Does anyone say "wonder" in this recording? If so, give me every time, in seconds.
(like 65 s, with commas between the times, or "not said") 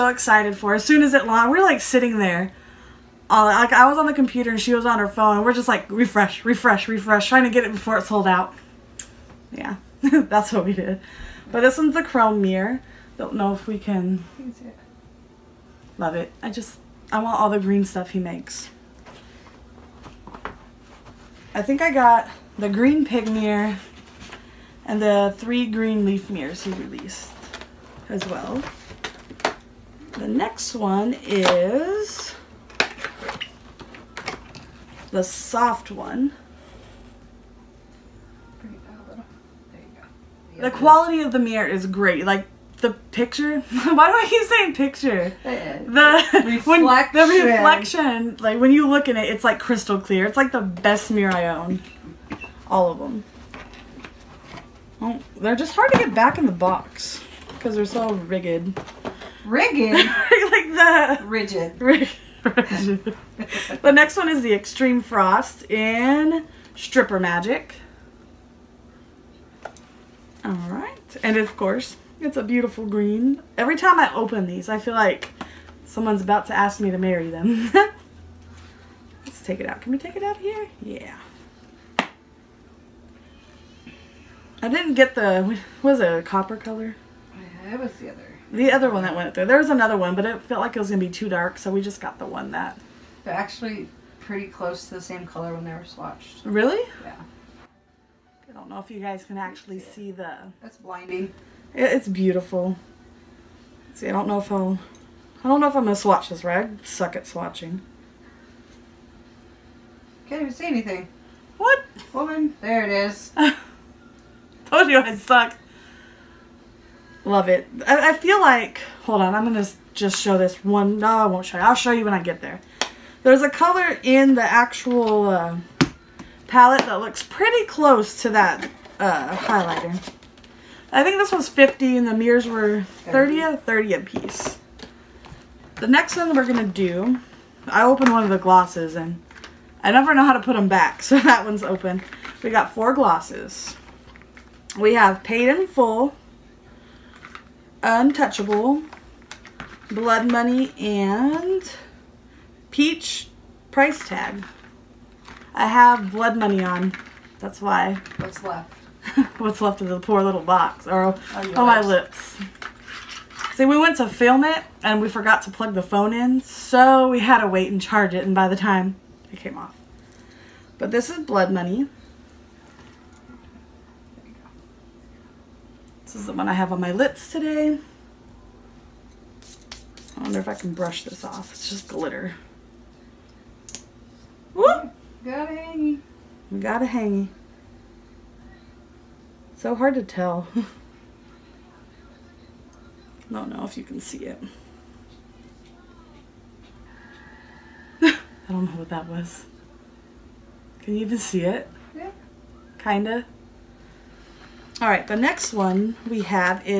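180 s.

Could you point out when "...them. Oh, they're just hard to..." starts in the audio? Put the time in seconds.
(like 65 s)
52 s.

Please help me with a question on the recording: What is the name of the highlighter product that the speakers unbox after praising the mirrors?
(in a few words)
Extreme Frost in Stripper Magic.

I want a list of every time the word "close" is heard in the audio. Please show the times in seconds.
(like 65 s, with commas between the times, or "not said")
94 s, 127 s.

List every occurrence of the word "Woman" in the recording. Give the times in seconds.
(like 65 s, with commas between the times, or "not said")
112 s.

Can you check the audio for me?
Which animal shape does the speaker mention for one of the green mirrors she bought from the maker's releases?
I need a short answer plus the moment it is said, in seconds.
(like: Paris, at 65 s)
pig, at 22 s.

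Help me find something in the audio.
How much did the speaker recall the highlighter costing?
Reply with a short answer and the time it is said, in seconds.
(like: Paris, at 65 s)
50, at 131 s.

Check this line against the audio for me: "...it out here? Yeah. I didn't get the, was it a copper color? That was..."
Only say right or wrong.
right.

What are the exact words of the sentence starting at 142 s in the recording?
We got four glosses we have Paid in Full, Untouchable, Blood Money, and Peach Price Tag.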